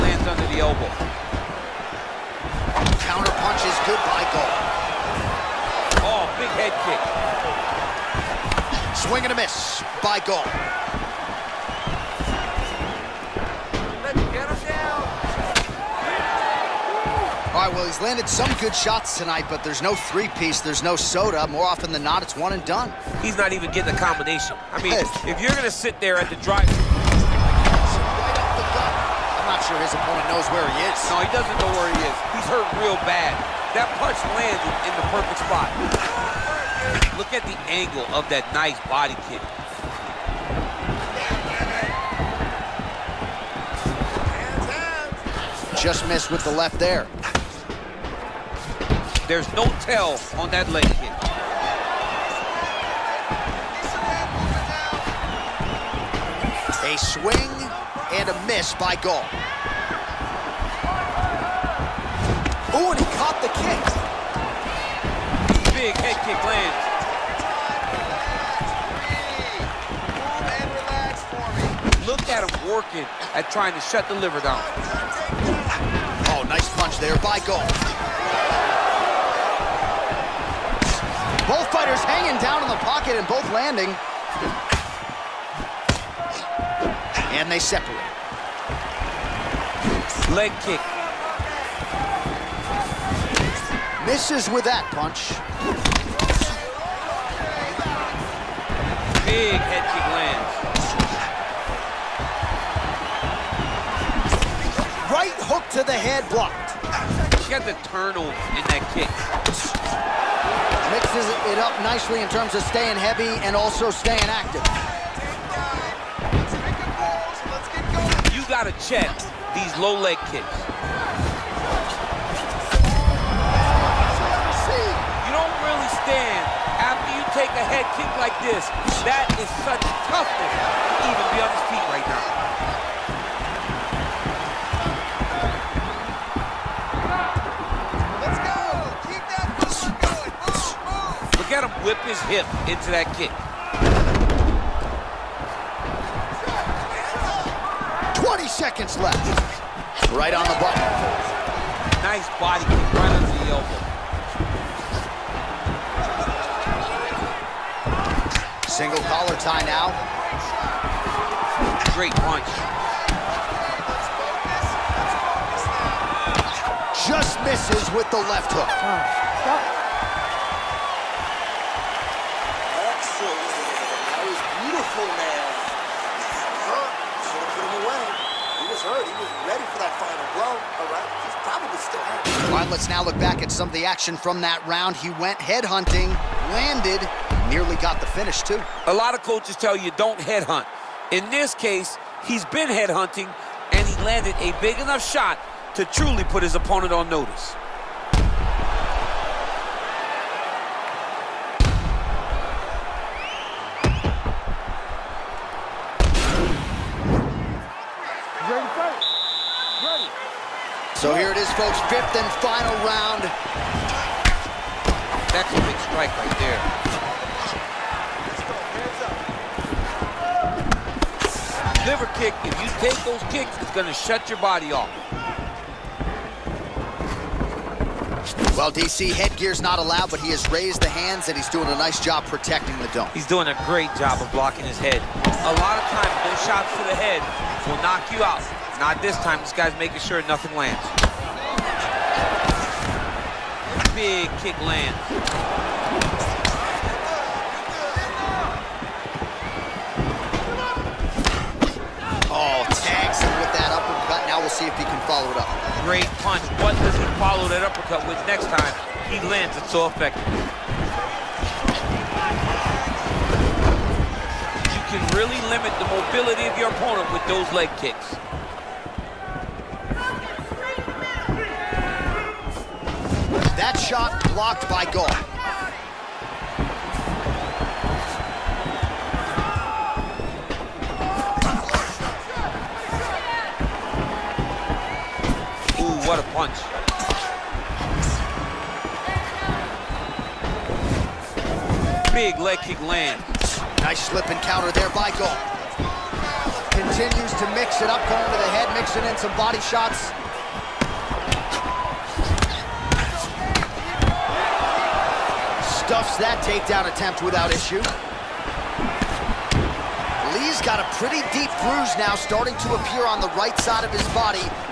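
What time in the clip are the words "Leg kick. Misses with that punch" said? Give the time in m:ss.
1:30.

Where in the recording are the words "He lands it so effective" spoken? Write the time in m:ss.
4:19.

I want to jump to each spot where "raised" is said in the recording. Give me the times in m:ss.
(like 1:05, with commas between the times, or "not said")
3:50.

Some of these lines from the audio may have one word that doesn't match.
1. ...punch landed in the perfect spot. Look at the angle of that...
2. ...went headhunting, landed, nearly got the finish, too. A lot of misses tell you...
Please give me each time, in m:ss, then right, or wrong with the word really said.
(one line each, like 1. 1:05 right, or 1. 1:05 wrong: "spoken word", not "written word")
1. 0:33 right
2. 3:05 wrong: "coaches", not "misses".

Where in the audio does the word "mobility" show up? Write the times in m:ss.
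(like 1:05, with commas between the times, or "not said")
4:25.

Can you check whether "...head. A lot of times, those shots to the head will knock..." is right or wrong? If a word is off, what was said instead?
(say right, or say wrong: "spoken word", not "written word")
right.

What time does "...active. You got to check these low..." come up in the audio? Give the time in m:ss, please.
1:54.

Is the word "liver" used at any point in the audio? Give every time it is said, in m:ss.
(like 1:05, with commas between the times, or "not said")
1:14, 3:41.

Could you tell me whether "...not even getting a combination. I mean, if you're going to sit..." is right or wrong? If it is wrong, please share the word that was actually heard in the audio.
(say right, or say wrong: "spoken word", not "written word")
right.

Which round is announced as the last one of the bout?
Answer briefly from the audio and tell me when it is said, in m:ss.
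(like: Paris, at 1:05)
Fifth, at 3:31.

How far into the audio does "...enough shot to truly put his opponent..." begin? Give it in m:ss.
3:14.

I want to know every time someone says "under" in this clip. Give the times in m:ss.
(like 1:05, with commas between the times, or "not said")
0:00, 2:33.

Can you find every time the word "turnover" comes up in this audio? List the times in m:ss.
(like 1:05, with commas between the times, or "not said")
1:47.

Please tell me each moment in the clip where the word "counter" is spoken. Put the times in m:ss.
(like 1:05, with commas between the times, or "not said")
0:03, 4:54.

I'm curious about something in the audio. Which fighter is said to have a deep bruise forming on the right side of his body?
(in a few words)
Lee.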